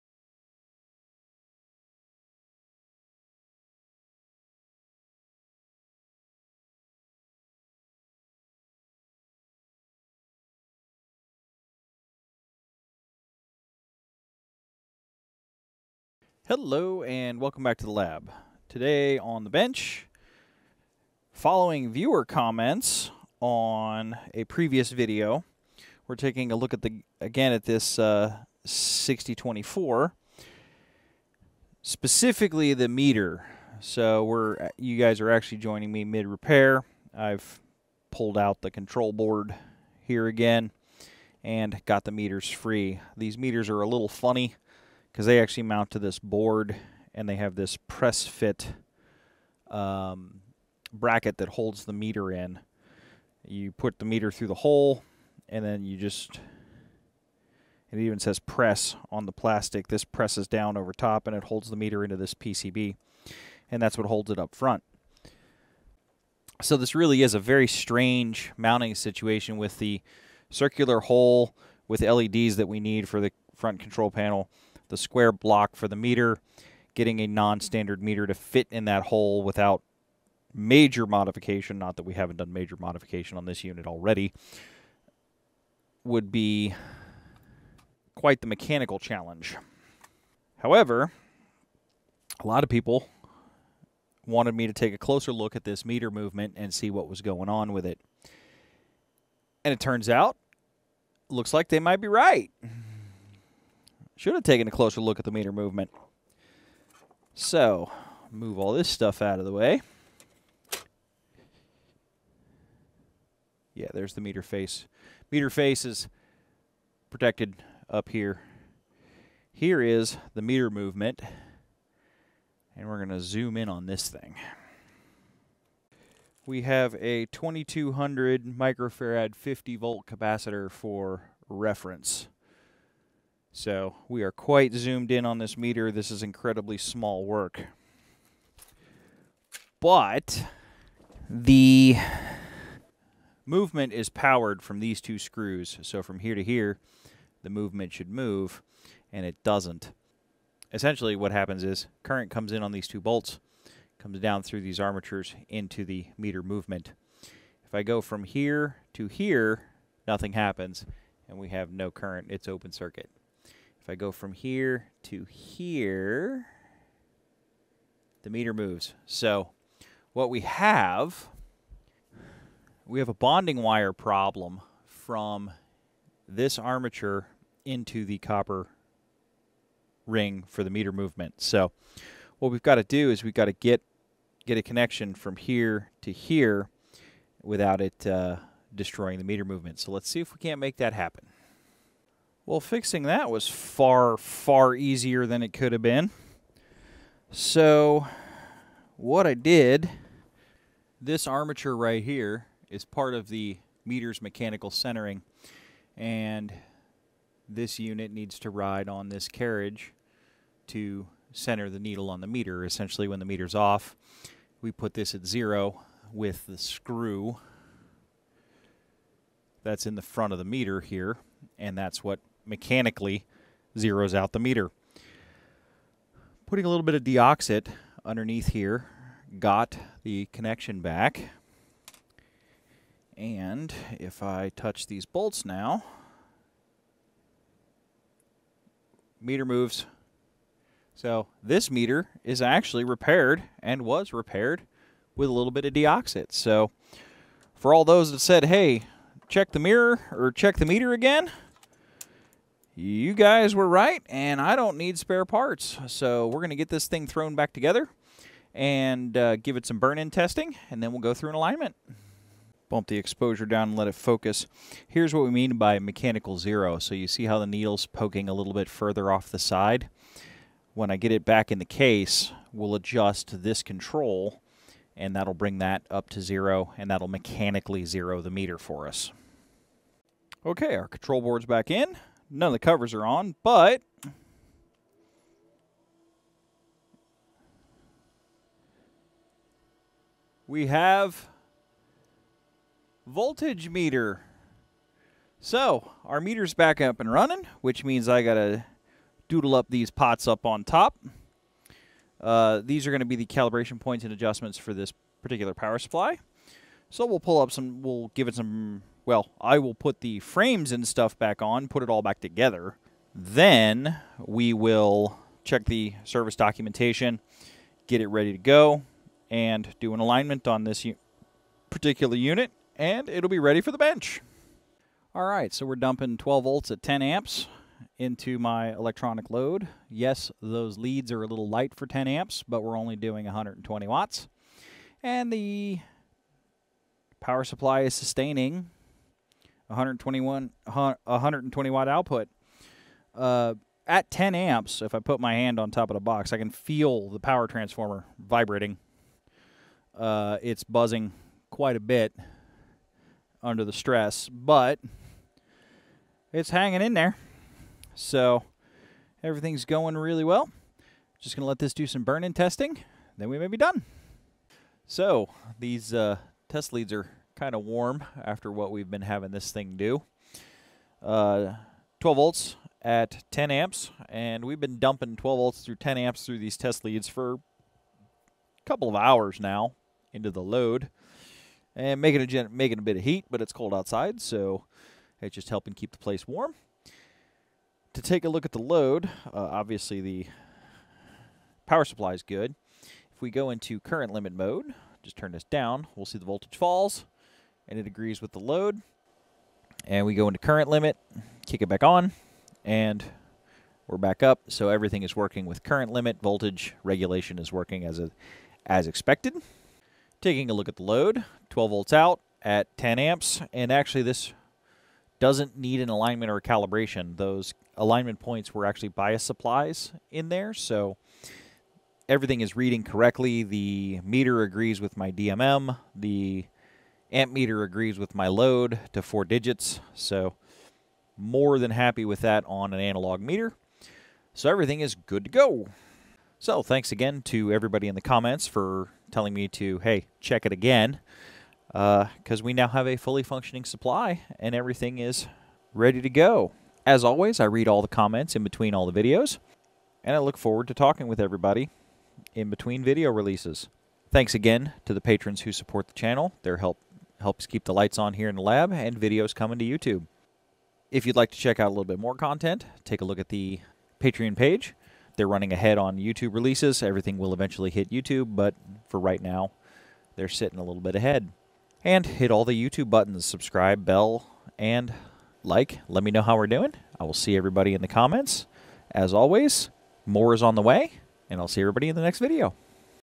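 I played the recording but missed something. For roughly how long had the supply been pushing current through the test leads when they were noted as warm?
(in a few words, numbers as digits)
A couple of hours.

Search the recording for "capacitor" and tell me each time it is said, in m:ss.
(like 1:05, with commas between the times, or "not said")
2:10.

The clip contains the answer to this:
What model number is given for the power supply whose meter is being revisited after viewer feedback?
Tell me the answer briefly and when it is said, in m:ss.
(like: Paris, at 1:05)
6024, at 0:28.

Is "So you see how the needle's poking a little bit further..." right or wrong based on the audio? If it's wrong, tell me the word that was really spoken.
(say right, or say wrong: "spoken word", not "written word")
right.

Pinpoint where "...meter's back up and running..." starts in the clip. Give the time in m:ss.
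4:56.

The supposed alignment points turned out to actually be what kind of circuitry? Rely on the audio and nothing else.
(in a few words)
Bias supplies.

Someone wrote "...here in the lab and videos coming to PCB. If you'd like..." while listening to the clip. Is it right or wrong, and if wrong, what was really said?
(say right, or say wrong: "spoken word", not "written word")
wrong: "YouTube", not "PCB".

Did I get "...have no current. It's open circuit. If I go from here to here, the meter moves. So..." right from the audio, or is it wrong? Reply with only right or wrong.
right.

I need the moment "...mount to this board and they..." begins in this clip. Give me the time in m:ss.
0:45.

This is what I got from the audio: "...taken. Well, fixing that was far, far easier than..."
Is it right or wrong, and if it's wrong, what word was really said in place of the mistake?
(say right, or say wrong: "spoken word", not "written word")
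wrong: "happen", not "taken".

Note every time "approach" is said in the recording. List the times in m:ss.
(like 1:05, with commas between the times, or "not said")
not said.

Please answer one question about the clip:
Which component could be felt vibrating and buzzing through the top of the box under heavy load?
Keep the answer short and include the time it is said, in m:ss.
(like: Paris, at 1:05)
Power transformer, at 5:47.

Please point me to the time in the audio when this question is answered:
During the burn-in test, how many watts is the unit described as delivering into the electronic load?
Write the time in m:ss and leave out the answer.
5:33.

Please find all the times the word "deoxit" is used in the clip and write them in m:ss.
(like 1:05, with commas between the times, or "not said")
3:47, 4:05.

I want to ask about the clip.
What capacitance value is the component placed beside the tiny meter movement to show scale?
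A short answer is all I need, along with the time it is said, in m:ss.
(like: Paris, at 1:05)
2200 microfarad, at 2:07.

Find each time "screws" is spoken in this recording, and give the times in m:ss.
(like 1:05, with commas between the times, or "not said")
2:25, 3:36.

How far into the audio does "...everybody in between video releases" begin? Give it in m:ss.
7:31.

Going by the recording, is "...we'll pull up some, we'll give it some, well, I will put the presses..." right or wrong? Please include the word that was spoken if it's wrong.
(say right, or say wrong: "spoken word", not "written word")
wrong: "frames", not "presses".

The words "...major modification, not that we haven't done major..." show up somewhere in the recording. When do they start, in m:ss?
1:20.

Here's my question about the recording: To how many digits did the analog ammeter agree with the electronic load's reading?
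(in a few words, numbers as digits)
4.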